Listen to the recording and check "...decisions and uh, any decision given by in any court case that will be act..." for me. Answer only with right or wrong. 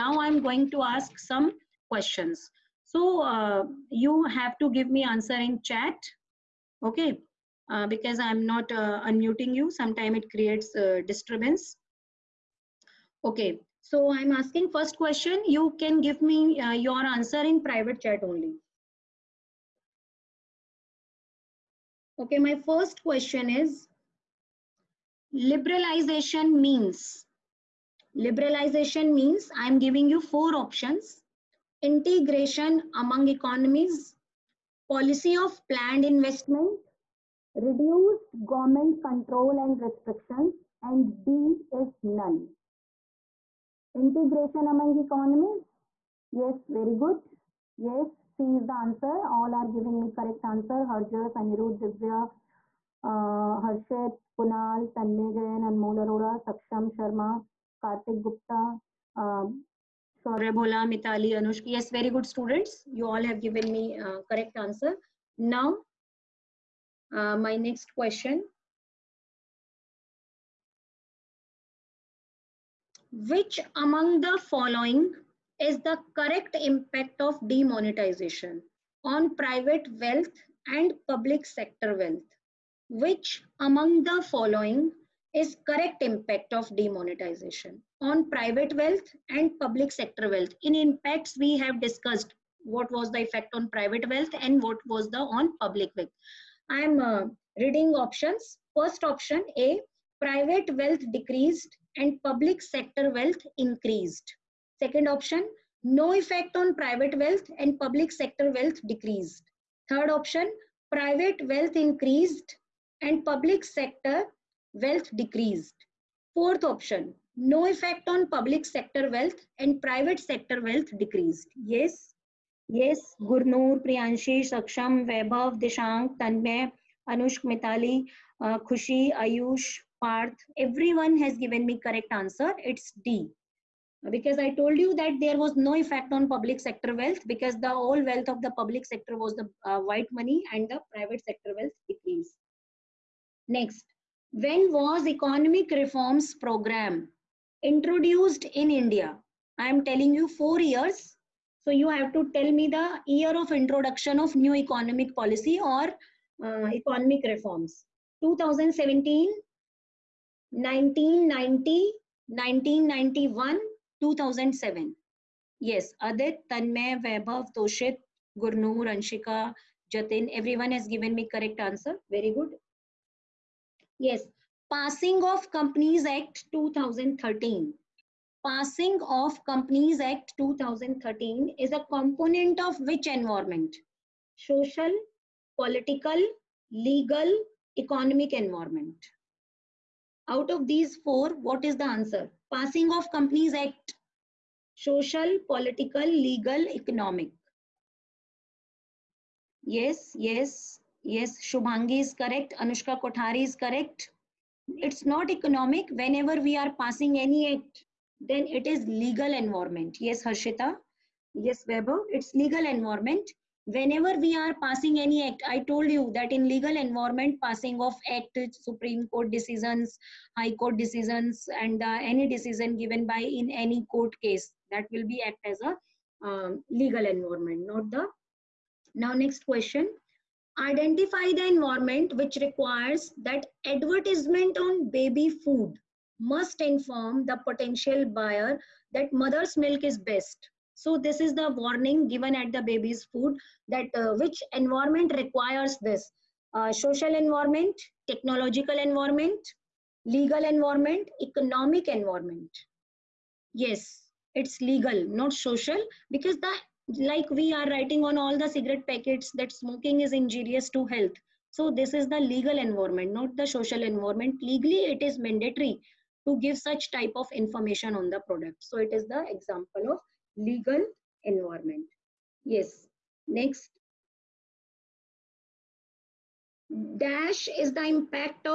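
right.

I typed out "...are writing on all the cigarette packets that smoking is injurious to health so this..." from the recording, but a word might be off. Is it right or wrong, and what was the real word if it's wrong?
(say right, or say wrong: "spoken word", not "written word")
right.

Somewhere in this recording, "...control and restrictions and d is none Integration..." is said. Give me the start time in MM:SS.
00:39.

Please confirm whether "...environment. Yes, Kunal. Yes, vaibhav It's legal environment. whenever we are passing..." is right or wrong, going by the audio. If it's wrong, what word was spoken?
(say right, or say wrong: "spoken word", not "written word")
wrong: "Harshita", not "Kunal".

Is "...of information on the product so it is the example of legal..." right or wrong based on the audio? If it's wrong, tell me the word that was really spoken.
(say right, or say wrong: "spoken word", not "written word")
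right.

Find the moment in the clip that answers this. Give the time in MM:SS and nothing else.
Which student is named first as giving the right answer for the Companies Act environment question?
03:21.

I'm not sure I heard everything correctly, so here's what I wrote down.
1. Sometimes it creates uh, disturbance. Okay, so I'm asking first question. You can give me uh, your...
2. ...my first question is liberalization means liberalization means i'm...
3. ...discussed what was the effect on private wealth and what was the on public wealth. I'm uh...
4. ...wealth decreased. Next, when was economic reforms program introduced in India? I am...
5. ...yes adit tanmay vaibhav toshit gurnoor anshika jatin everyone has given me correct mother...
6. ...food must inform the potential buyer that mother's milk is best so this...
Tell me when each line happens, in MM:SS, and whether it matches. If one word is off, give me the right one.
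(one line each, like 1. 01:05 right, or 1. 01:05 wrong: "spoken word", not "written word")
1. 00:09 right
2. 00:22 right
3. 01:31 right
4. 02:21 right
5. 02:45 wrong: "answer", not "mother"
6. 03:55 right.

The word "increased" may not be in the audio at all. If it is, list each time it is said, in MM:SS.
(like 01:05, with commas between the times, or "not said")
01:43, 01:51.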